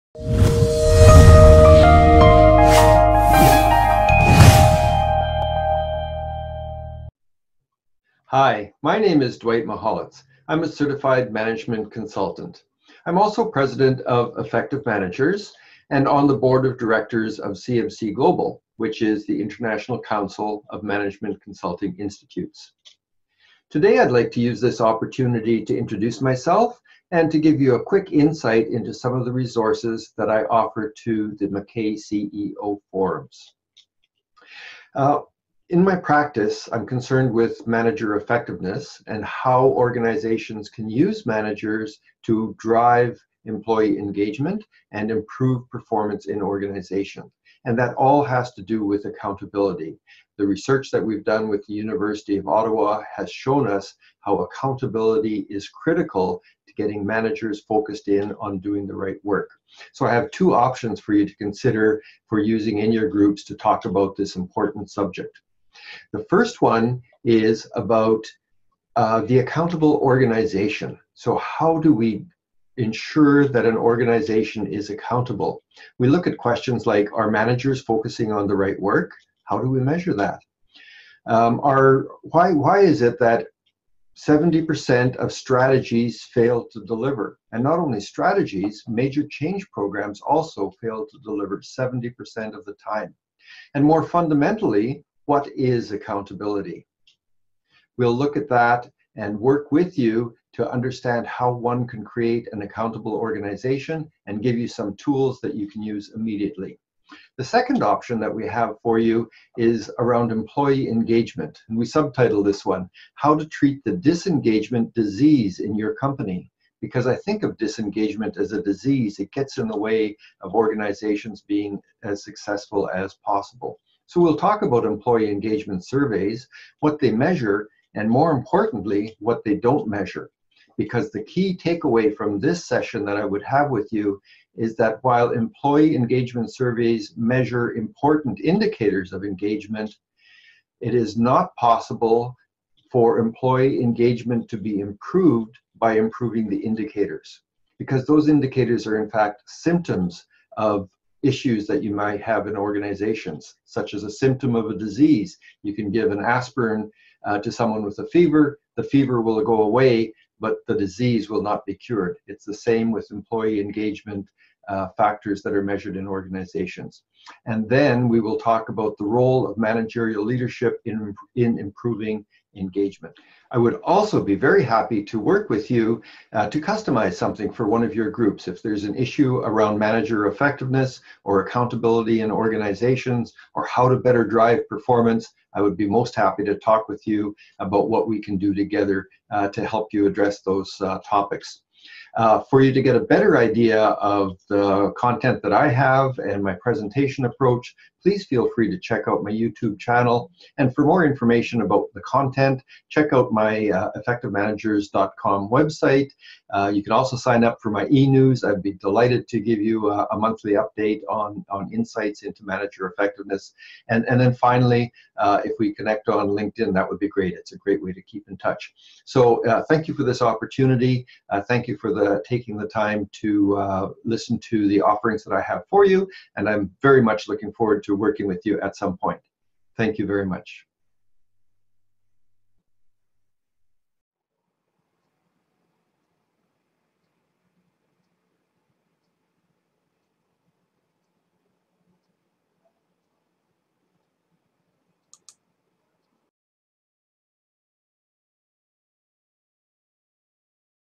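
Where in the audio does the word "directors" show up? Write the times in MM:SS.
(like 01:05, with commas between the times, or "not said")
00:16.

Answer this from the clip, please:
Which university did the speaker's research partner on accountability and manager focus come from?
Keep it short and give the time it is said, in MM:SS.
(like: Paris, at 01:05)
University of Ottawa, at 00:51.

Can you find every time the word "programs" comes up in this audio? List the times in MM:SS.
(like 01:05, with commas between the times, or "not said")
01:29.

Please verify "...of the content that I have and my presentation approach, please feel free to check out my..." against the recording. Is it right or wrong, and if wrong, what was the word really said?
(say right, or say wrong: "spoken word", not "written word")
right.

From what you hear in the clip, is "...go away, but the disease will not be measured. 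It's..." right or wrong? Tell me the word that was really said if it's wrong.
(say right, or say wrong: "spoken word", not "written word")
wrong: "cured", not "measured".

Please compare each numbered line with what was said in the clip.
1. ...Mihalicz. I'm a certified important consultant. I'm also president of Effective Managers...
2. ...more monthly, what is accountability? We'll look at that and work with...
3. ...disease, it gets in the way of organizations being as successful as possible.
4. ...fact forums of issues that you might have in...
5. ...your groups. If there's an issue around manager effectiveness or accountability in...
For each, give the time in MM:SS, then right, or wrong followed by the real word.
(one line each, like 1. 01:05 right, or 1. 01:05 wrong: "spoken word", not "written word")
1. 00:09 wrong: "management", not "important"
2. 01:33 wrong: "fundamentally", not "monthly"
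3. 01:58 right
4. 02:29 wrong: "symptoms", not "forums"
5. 02:57 right.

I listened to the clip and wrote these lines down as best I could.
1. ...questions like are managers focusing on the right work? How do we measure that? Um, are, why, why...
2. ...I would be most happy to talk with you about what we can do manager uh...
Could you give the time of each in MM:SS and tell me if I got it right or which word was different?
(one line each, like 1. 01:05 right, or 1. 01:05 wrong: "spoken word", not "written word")
1. 01:16 right
2. 03:05 wrong: "together", not "manager".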